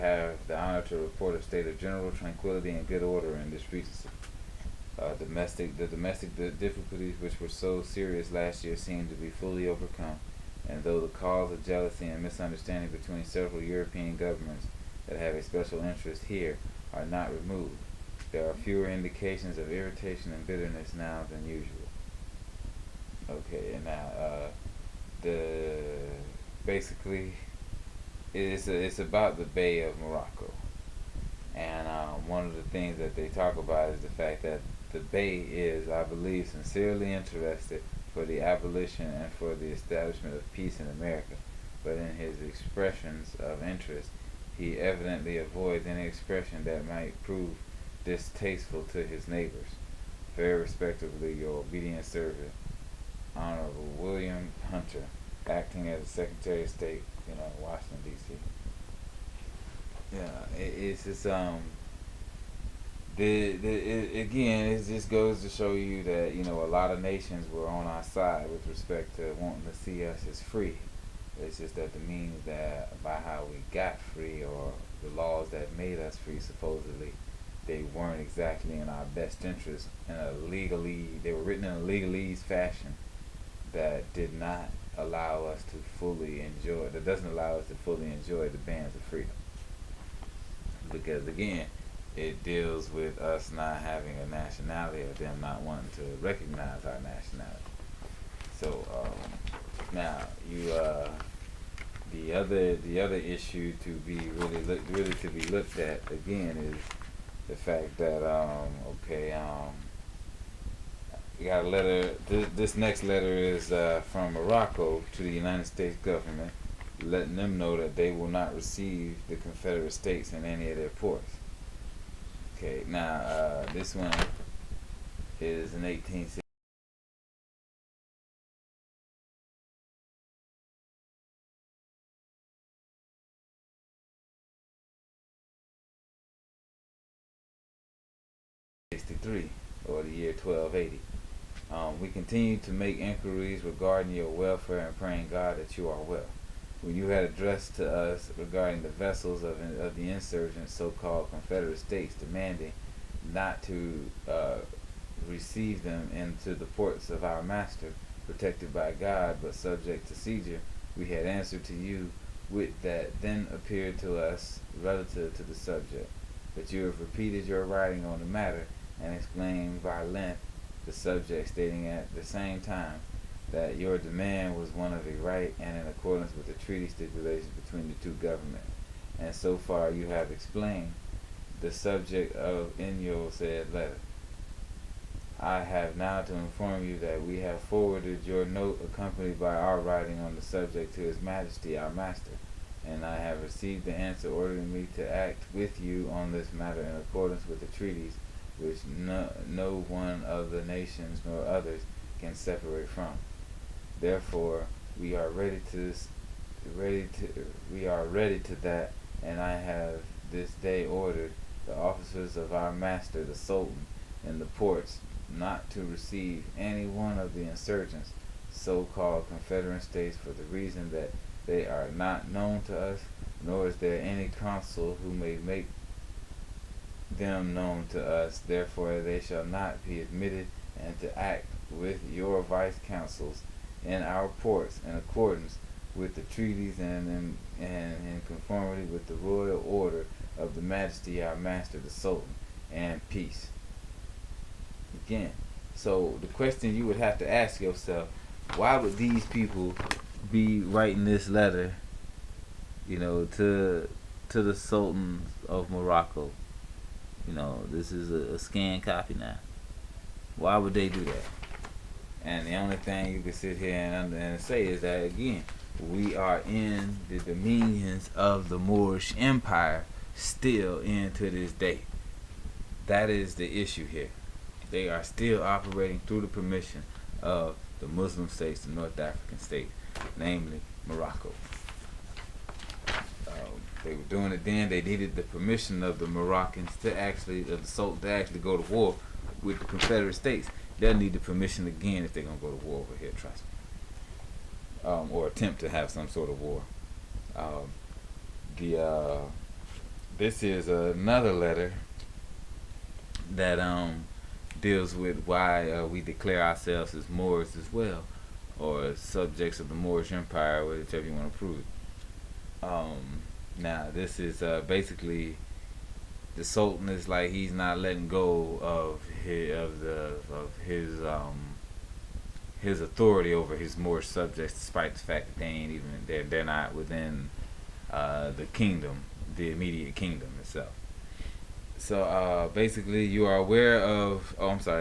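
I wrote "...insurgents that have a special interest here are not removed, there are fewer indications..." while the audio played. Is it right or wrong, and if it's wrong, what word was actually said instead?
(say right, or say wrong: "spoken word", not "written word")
wrong: "governments", not "insurgents".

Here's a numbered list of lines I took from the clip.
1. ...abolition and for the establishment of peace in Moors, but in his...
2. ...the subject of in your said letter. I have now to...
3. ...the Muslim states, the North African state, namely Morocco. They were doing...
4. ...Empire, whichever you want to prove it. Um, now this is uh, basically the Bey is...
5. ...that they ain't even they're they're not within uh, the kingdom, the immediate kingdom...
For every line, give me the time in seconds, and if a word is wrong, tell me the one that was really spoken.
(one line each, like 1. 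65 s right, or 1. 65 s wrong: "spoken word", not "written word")
1. 38 s wrong: "America", not "Moors"
2. 181 s right
3. 277 s right
4. 310 s wrong: "Sultan", not "Bey"
5. 325 s right.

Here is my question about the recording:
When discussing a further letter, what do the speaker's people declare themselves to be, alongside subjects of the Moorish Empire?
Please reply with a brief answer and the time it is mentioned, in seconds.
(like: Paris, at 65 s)
Moors, at 307 s.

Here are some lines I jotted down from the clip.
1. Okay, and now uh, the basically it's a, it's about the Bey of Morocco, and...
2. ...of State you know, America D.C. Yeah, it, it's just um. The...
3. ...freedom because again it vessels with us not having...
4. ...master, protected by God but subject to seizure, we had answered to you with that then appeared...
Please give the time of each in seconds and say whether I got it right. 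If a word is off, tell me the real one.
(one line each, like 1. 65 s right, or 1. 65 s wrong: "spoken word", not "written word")
1. 23 s right
2. 56 s wrong: "Washington", not "America"
3. 89 s wrong: "deals", not "vessels"
4. 157 s right.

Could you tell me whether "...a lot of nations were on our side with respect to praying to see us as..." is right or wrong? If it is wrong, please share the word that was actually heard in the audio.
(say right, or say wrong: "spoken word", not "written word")
wrong: "wanting", not "praying".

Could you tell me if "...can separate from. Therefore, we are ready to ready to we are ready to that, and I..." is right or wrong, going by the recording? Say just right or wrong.
right.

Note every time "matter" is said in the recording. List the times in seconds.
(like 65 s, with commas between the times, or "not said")
168 s, 196 s.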